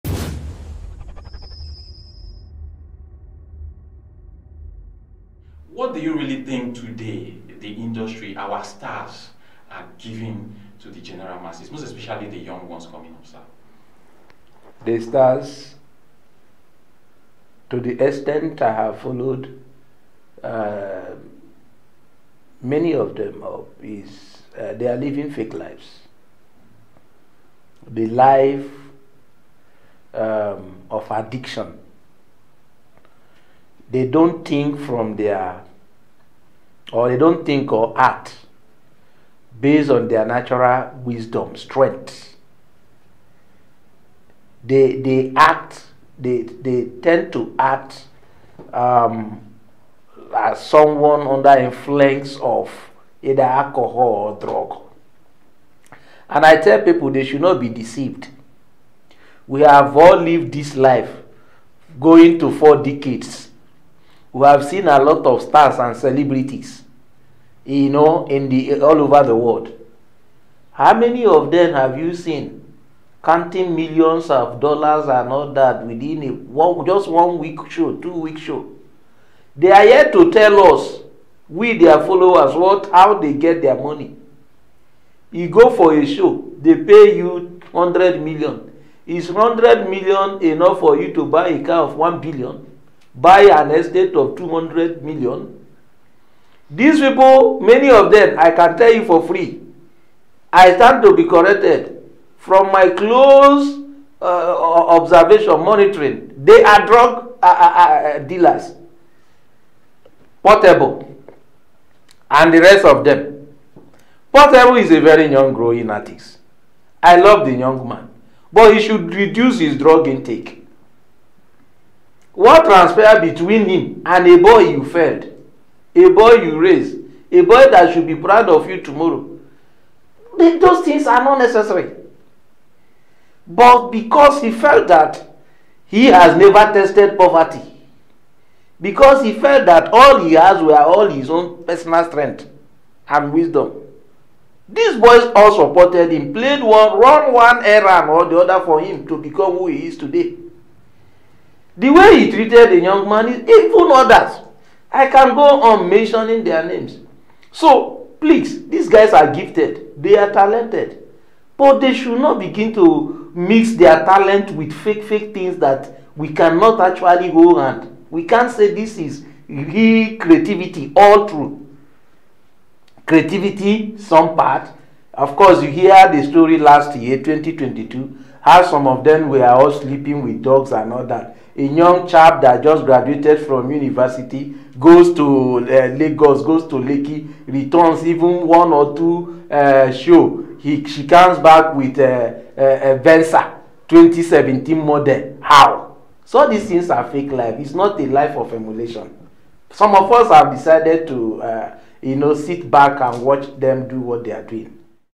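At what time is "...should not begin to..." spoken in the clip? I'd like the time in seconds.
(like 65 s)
161 s.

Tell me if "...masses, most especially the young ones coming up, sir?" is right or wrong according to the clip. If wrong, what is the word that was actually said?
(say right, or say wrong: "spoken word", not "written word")
right.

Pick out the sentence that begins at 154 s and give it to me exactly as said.
I can go on mentioning their names.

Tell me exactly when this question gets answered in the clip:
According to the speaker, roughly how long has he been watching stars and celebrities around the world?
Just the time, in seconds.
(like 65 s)
62 s.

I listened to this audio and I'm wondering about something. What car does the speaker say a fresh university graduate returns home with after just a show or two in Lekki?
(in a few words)
2017 Venza.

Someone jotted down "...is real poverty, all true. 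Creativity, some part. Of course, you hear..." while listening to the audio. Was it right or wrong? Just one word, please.
wrong.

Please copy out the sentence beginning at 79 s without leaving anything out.
They are here to tell us, we their followers, what how they get their money.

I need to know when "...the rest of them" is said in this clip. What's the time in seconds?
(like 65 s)
112 s.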